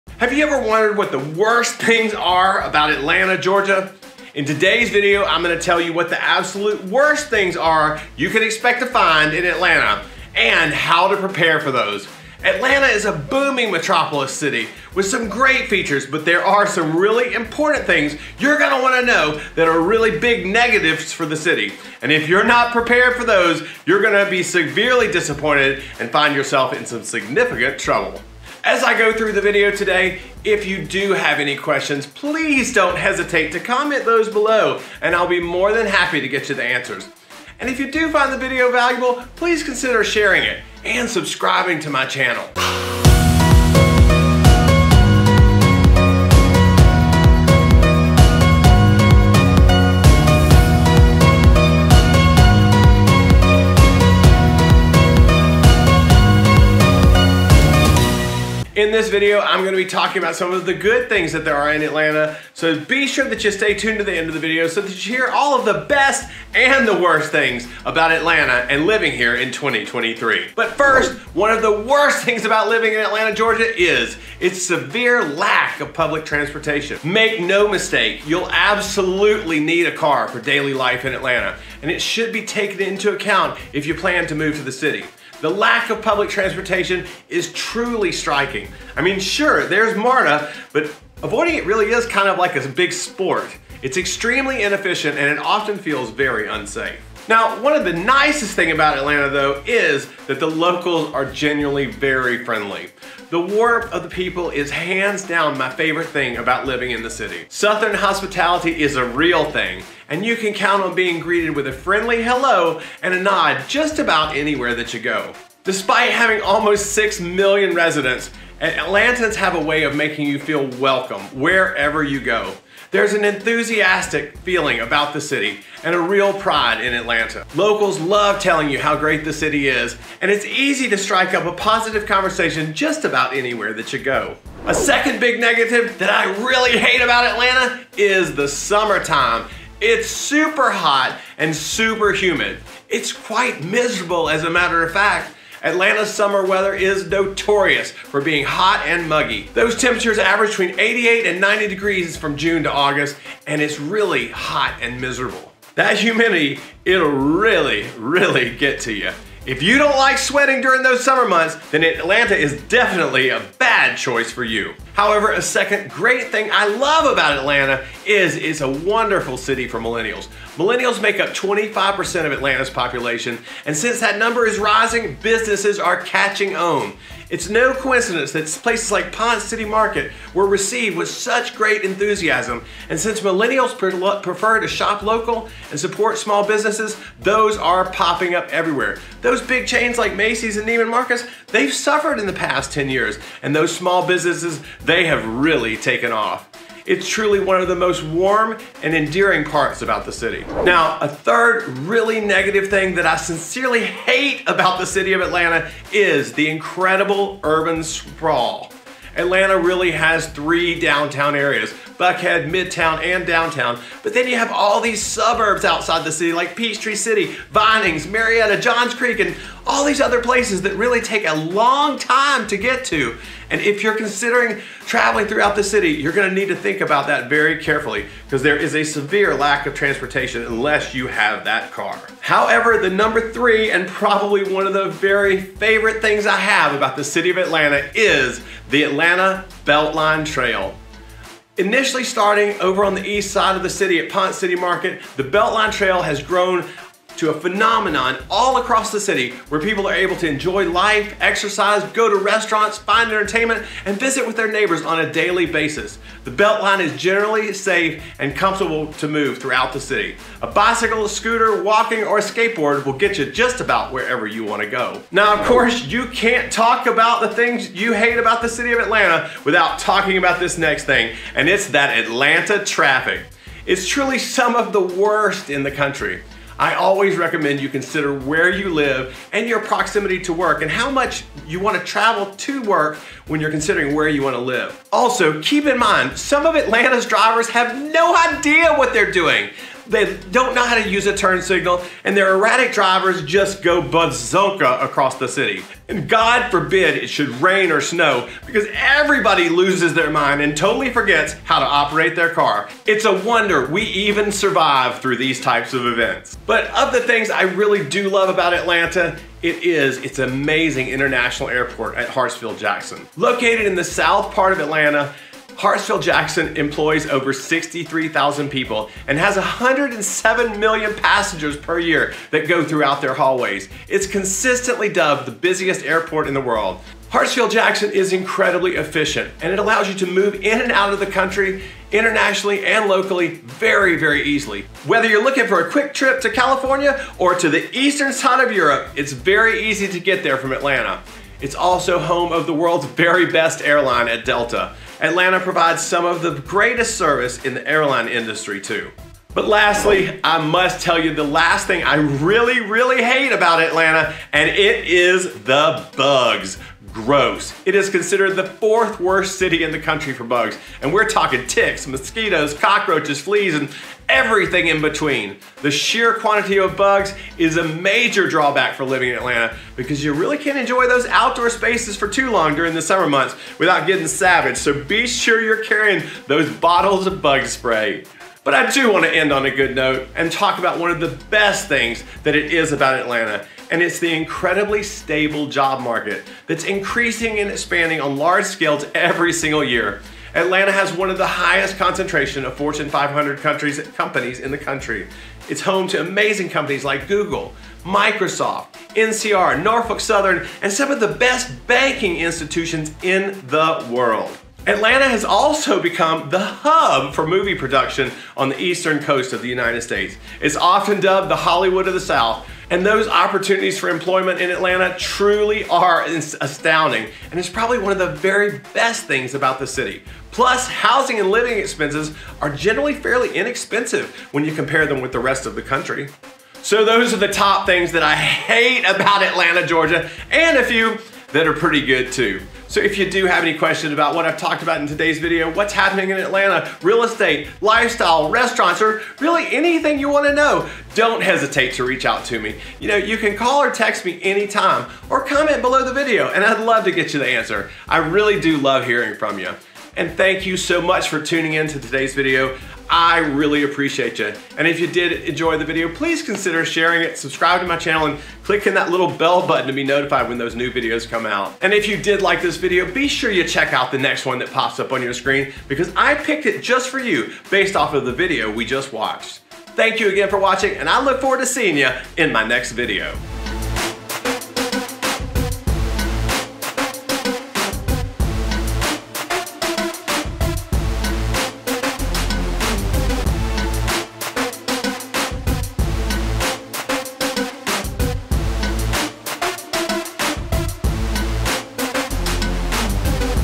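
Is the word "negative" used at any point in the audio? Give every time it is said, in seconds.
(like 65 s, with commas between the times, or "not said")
20 s, 135 s, 202 s.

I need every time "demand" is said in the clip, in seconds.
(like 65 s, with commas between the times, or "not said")
not said.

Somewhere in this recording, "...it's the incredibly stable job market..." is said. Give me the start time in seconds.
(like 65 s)
383 s.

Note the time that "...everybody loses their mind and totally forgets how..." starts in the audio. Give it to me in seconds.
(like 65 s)
298 s.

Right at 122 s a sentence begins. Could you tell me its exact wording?
There's an enthusiastic feeling about the city and a real pride in Atlanta.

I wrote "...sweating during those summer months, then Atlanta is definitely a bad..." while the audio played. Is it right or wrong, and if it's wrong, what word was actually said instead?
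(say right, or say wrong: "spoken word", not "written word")
right.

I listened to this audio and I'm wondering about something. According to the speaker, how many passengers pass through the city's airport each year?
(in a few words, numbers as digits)
107 million.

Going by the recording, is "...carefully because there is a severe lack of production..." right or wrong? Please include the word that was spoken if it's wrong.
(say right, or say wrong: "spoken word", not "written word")
wrong: "transportation", not "production".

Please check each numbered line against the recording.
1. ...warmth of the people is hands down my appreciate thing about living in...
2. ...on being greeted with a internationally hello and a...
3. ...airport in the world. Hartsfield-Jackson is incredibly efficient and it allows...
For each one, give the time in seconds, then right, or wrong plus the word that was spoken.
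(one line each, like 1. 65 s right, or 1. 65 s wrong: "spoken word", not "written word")
1. 103 s wrong: "favorite", not "appreciate"
2. 110 s wrong: "friendly", not "internationally"
3. 325 s right.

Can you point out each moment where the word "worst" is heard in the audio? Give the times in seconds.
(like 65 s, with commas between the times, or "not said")
1 s, 6 s, 66 s, 71 s, 274 s, 358 s.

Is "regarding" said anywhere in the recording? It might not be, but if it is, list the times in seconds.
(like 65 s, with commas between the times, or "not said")
not said.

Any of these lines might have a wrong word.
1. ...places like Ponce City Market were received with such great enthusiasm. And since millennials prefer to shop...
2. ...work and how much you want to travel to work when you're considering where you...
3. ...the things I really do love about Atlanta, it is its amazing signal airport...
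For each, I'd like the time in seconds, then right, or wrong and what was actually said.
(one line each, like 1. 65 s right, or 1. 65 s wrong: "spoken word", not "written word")
1. 178 s right
2. 280 s right
3. 306 s wrong: "international", not "signal".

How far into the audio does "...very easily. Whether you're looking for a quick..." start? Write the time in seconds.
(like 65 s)
333 s.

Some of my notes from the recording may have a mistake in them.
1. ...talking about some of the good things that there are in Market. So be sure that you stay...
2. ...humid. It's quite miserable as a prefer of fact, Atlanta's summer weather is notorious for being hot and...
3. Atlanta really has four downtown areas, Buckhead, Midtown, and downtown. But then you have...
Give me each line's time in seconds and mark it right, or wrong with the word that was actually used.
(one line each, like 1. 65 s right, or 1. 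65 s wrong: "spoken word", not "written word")
1. 59 s wrong: "Atlanta", not "Market"
2. 142 s wrong: "matter", not "prefer"
3. 209 s wrong: "three", not "four".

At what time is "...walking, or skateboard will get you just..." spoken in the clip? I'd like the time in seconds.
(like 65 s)
261 s.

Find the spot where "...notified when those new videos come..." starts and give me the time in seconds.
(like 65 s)
459 s.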